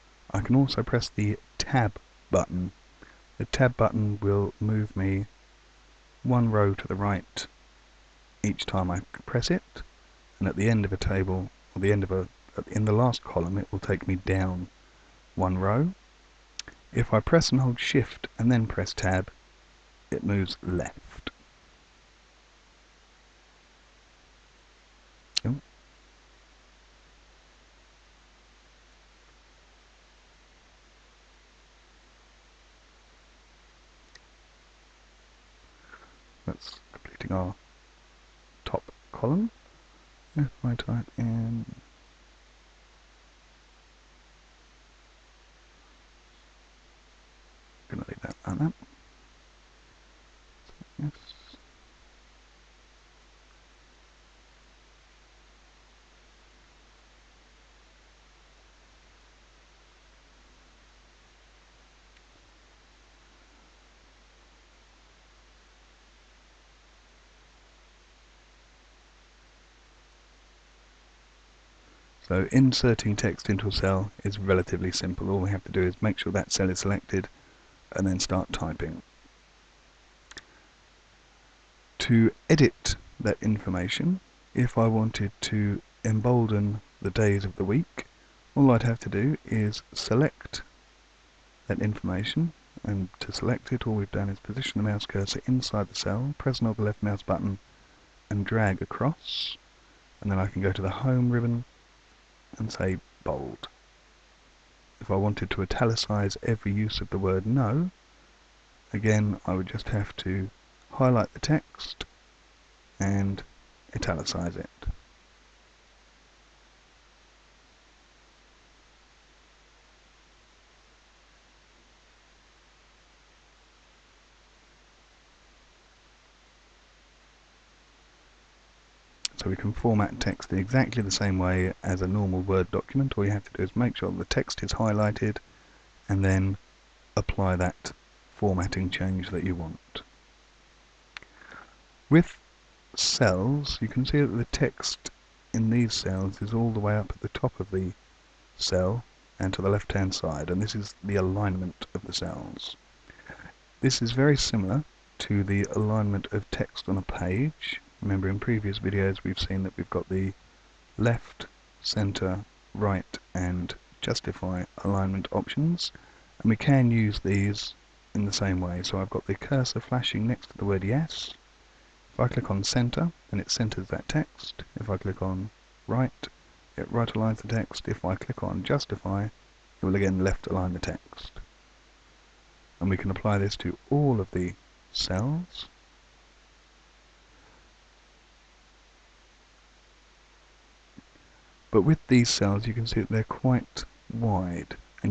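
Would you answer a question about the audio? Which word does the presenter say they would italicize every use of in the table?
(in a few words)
No.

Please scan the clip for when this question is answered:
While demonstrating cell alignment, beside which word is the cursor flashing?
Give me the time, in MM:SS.
02:50.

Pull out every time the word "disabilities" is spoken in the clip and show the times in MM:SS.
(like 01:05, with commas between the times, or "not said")
not said.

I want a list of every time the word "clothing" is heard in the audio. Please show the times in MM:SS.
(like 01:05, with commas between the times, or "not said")
not said.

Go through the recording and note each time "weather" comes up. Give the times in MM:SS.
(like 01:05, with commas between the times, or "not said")
not said.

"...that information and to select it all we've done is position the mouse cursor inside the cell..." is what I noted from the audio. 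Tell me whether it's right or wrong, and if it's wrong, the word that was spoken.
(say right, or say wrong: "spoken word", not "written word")
right.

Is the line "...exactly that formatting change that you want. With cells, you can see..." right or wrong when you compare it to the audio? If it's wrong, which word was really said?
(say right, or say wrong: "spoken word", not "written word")
wrong: "apply", not "exactly".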